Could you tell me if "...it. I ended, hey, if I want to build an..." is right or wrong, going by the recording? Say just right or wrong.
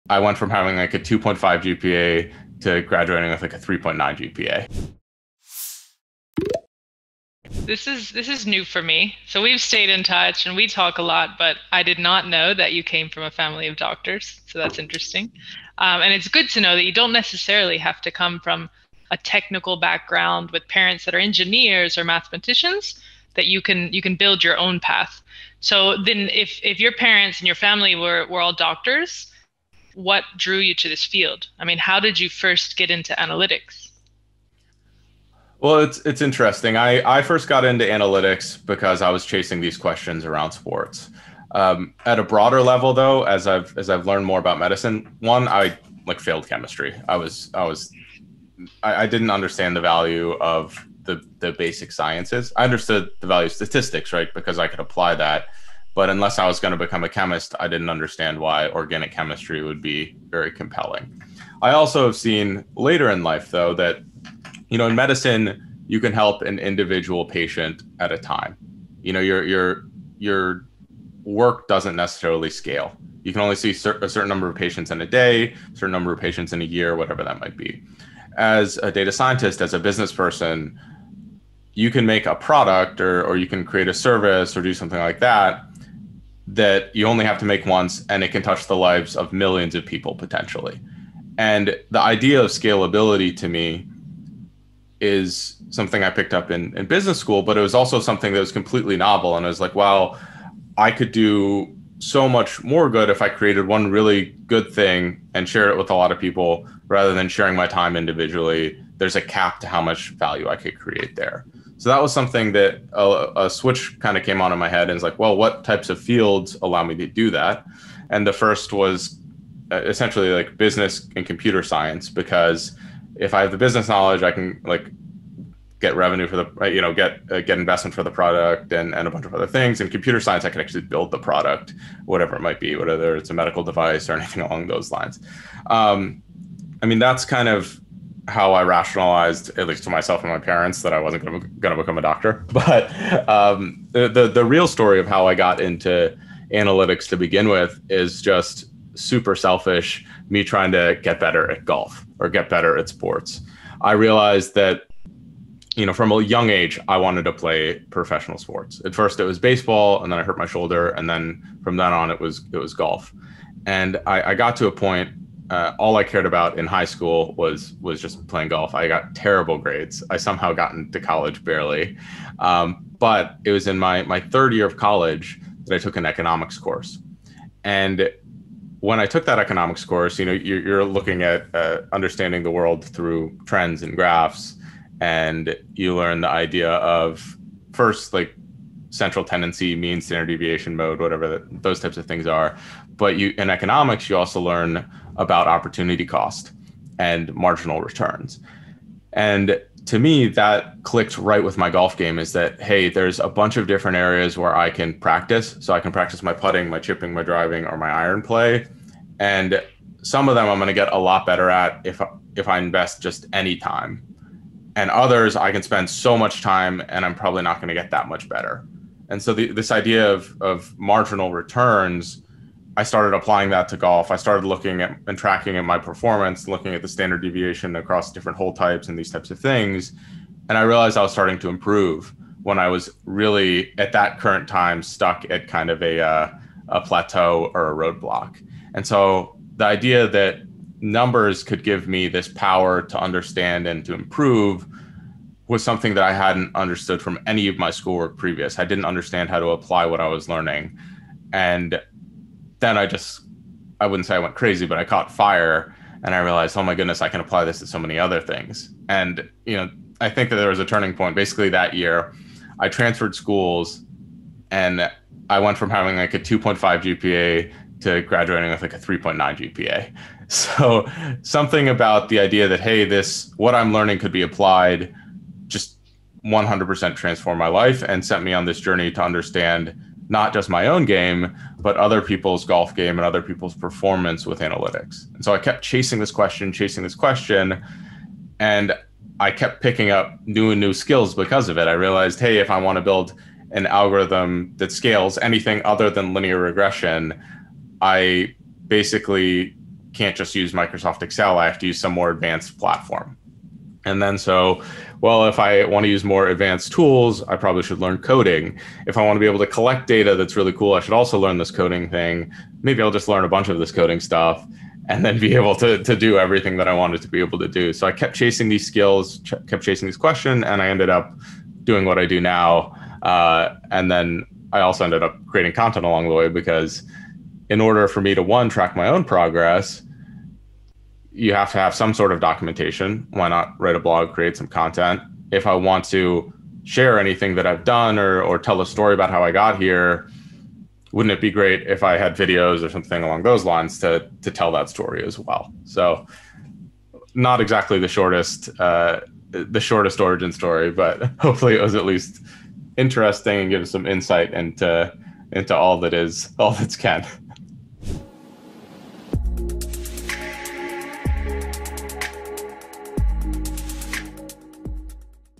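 wrong.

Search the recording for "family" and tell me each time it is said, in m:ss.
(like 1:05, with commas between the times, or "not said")
0:13, 0:27.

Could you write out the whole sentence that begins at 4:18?
And you know, I think that there was a turning point.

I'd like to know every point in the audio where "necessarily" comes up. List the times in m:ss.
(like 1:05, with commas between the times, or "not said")
0:17, 1:11.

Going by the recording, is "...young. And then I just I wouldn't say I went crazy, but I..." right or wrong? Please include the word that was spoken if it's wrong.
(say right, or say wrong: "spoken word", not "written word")
wrong: "learning", not "young".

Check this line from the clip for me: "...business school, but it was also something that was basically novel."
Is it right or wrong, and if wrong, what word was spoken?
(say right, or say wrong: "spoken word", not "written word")
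wrong: "completely", not "basically".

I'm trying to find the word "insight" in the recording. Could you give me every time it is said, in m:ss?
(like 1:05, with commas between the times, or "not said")
5:53.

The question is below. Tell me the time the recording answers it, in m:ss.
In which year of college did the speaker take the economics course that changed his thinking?
2:54.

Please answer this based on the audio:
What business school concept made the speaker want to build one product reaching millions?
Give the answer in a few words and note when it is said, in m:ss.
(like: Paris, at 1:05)
scalability, at 1:32.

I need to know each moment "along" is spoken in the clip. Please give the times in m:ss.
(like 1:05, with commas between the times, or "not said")
2:14, 5:25, 5:43.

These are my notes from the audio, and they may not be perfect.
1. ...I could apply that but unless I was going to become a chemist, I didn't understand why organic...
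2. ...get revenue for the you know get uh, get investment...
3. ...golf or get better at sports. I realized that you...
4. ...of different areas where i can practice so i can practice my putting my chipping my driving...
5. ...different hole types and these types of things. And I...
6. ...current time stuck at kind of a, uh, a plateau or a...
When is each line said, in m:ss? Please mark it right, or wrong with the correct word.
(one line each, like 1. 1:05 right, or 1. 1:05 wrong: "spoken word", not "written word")
1. 0:54 right
2. 2:05 right
3. 2:31 right
4. 3:23 right
5. 3:48 right
6. 3:54 right.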